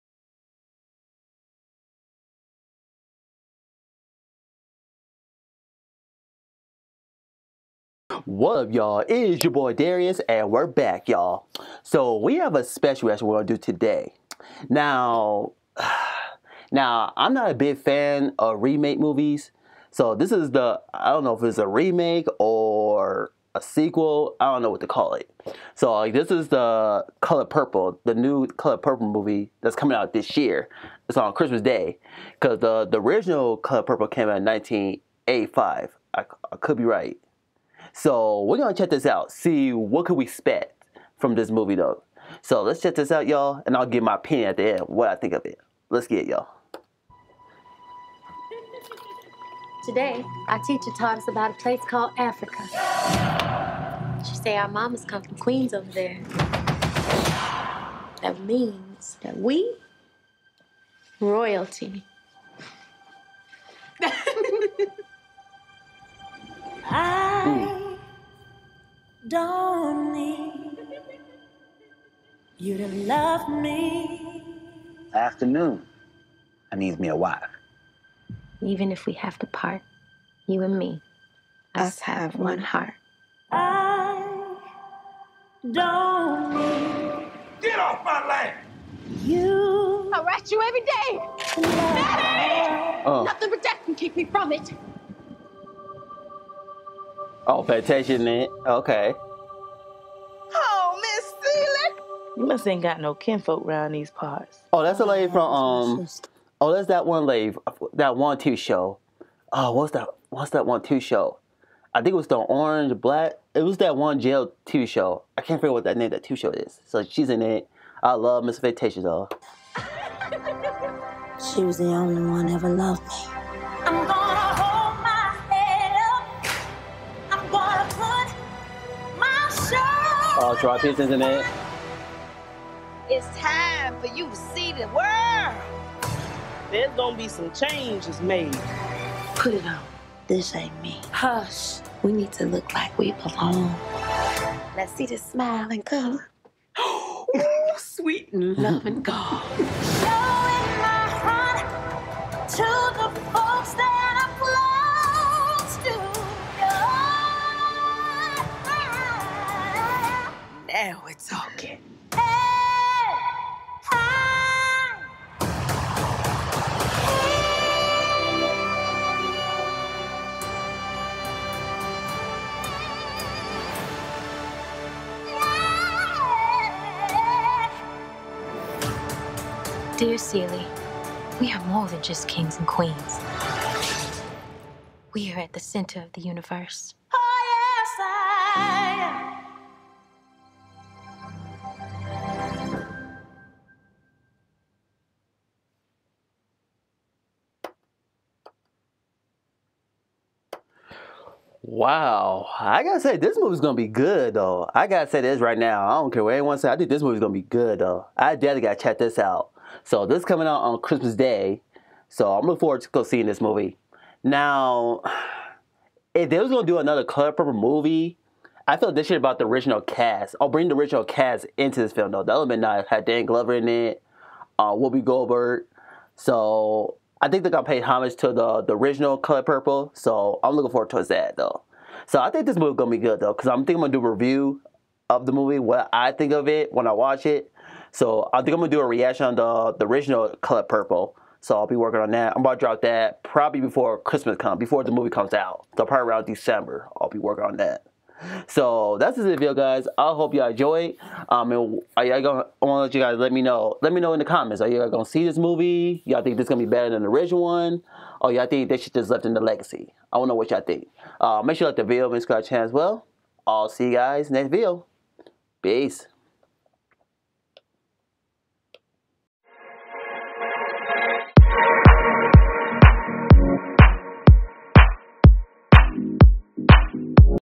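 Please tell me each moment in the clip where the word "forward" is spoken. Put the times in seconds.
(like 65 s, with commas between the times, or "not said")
212 s, 230 s.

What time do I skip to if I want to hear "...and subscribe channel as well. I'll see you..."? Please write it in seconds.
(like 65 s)
262 s.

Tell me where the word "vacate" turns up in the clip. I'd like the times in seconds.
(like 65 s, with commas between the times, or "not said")
not said.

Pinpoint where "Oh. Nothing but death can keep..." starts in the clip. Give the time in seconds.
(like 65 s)
93 s.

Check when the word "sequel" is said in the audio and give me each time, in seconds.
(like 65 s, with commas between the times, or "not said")
23 s.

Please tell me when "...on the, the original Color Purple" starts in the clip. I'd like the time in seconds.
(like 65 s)
239 s.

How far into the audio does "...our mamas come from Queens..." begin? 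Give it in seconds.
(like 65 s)
54 s.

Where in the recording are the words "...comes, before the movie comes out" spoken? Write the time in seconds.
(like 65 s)
244 s.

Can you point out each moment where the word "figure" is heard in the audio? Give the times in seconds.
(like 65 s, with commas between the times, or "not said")
115 s.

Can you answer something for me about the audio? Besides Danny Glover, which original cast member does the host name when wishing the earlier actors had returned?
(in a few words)
Whoopi Goldberg.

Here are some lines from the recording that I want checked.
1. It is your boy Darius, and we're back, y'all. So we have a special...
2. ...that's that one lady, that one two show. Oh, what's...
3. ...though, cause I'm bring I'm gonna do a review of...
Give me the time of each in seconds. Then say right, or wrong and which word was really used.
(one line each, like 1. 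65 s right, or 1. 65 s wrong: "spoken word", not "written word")
1. 8 s right
2. 106 s right
3. 233 s wrong: "thinking", not "bring".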